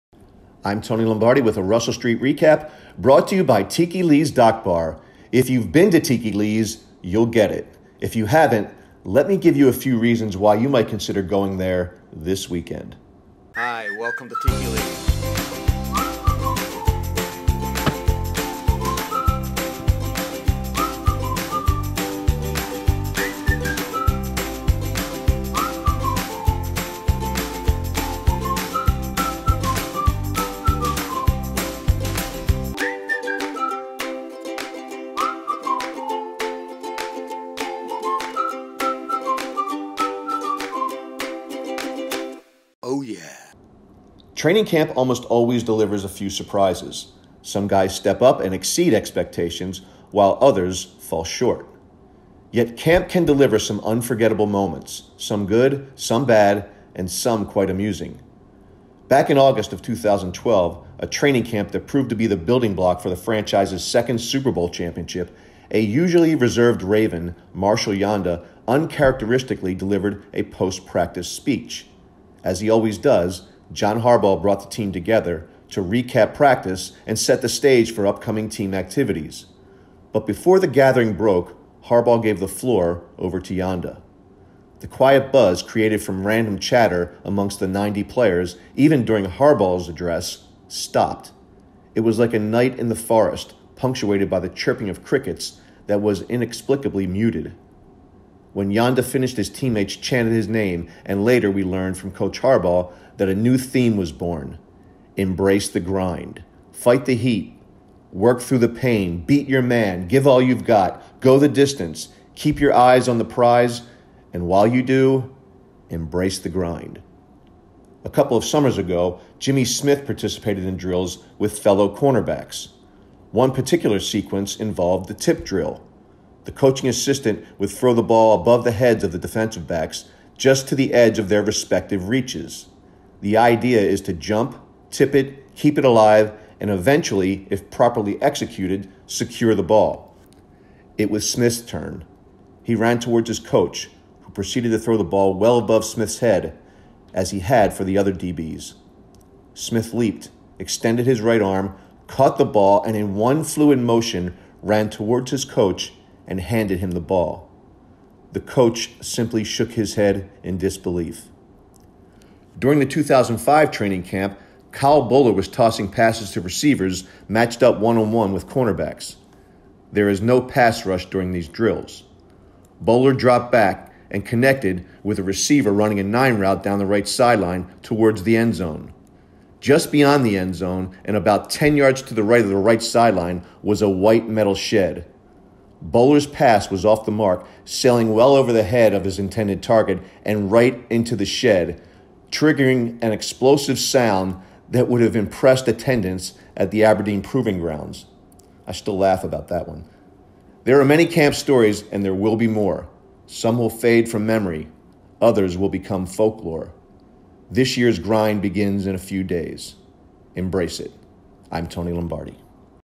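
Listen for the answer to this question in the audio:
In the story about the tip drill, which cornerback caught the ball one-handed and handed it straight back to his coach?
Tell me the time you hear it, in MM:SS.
01:59.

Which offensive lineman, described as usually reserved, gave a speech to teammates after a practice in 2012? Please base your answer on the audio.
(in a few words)
Marshal Yanda.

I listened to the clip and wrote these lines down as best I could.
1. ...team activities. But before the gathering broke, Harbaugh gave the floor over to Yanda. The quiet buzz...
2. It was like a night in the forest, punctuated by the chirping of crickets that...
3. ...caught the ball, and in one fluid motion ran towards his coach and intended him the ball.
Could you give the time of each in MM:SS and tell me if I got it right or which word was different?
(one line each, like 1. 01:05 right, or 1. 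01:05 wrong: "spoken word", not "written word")
1. 01:18 right
2. 01:31 right
3. 02:32 wrong: "handed", not "intended".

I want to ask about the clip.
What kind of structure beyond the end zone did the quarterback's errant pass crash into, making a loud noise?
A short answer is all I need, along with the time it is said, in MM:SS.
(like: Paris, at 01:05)
a white metal shed, at 03:03.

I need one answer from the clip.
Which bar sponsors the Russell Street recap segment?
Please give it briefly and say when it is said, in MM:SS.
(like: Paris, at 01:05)
Tiki Lee's Dock Bar, at 00:03.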